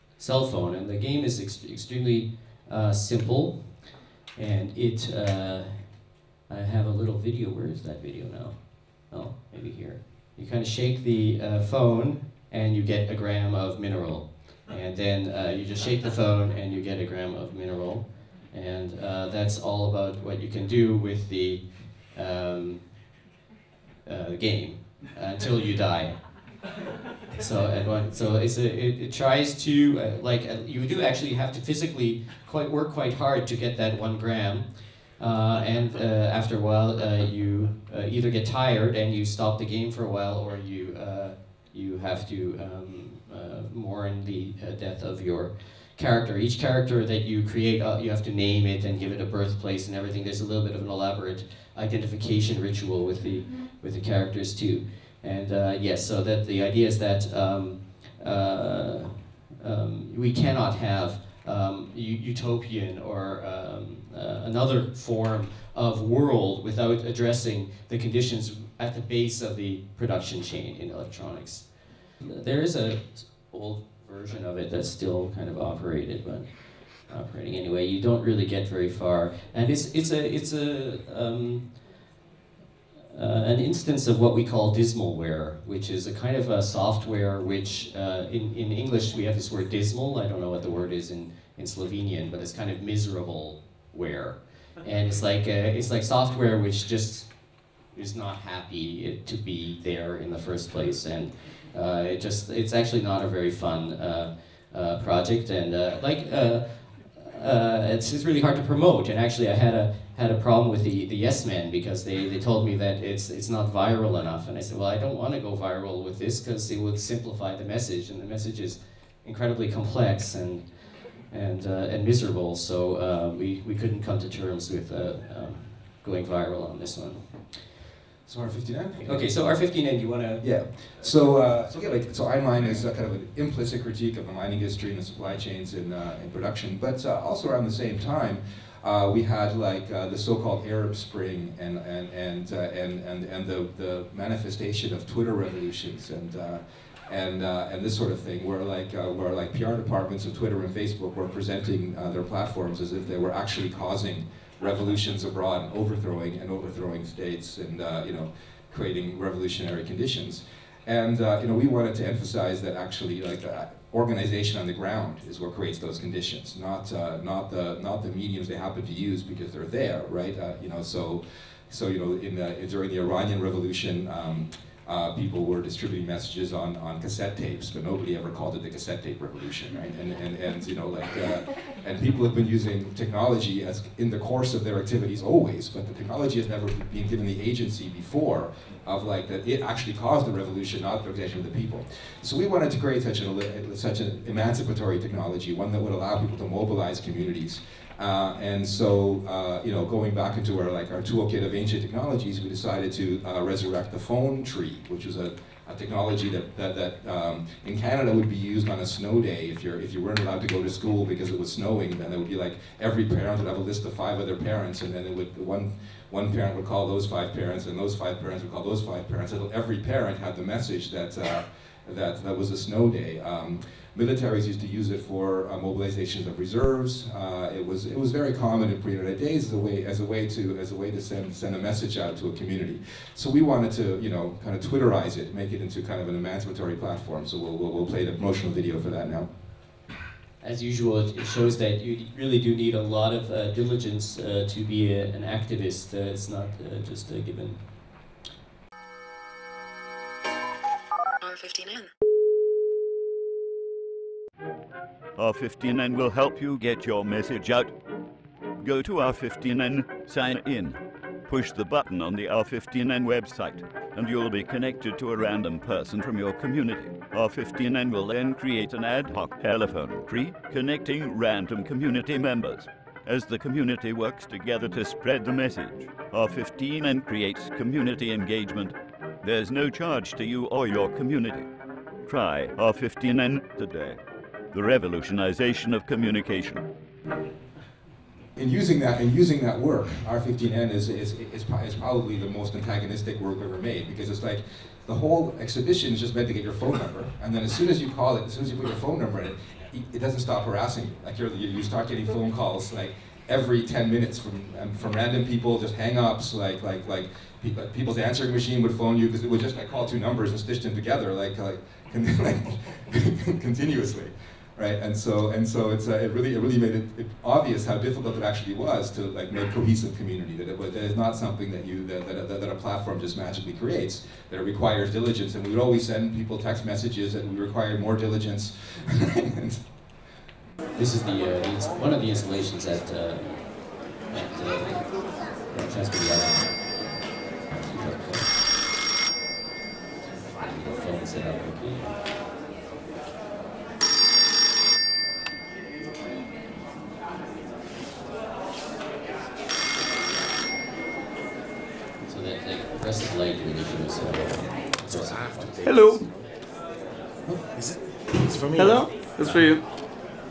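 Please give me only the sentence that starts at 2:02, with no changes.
So uh, we we couldn't come to terms with uh, um, going viral on this one.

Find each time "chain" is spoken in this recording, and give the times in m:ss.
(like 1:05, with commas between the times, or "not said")
1:10, 2:15.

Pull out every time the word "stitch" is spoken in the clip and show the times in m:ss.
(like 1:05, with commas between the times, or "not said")
5:10.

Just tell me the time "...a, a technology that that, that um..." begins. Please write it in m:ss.
3:25.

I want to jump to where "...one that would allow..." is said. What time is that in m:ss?
3:15.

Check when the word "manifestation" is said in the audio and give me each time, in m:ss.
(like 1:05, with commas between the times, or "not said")
2:24.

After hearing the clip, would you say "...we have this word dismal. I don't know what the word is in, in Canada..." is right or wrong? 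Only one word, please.
wrong.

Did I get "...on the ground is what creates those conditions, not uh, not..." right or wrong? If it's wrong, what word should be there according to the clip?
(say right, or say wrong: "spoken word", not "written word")
right.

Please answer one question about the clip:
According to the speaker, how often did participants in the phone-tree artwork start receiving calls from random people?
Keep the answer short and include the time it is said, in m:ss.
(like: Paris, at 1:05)
every 10 minutes, at 5:03.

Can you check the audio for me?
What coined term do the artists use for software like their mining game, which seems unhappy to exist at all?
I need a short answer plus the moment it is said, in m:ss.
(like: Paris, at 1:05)
dismalware, at 1:24.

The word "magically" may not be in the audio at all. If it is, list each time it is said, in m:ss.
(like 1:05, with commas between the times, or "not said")
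5:23.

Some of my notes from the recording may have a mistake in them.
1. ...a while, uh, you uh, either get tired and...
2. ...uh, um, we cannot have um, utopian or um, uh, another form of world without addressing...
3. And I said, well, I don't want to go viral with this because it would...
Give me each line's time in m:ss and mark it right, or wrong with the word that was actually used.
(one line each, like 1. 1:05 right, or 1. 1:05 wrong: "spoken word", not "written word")
1. 0:36 right
2. 0:58 right
3. 1:54 right.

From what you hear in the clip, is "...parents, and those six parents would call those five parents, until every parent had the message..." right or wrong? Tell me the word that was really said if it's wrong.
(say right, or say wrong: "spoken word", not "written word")
wrong: "five", not "six".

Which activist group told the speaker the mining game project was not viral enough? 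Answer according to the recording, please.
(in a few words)
the Yes Men.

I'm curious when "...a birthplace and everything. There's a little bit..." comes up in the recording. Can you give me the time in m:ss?
0:49.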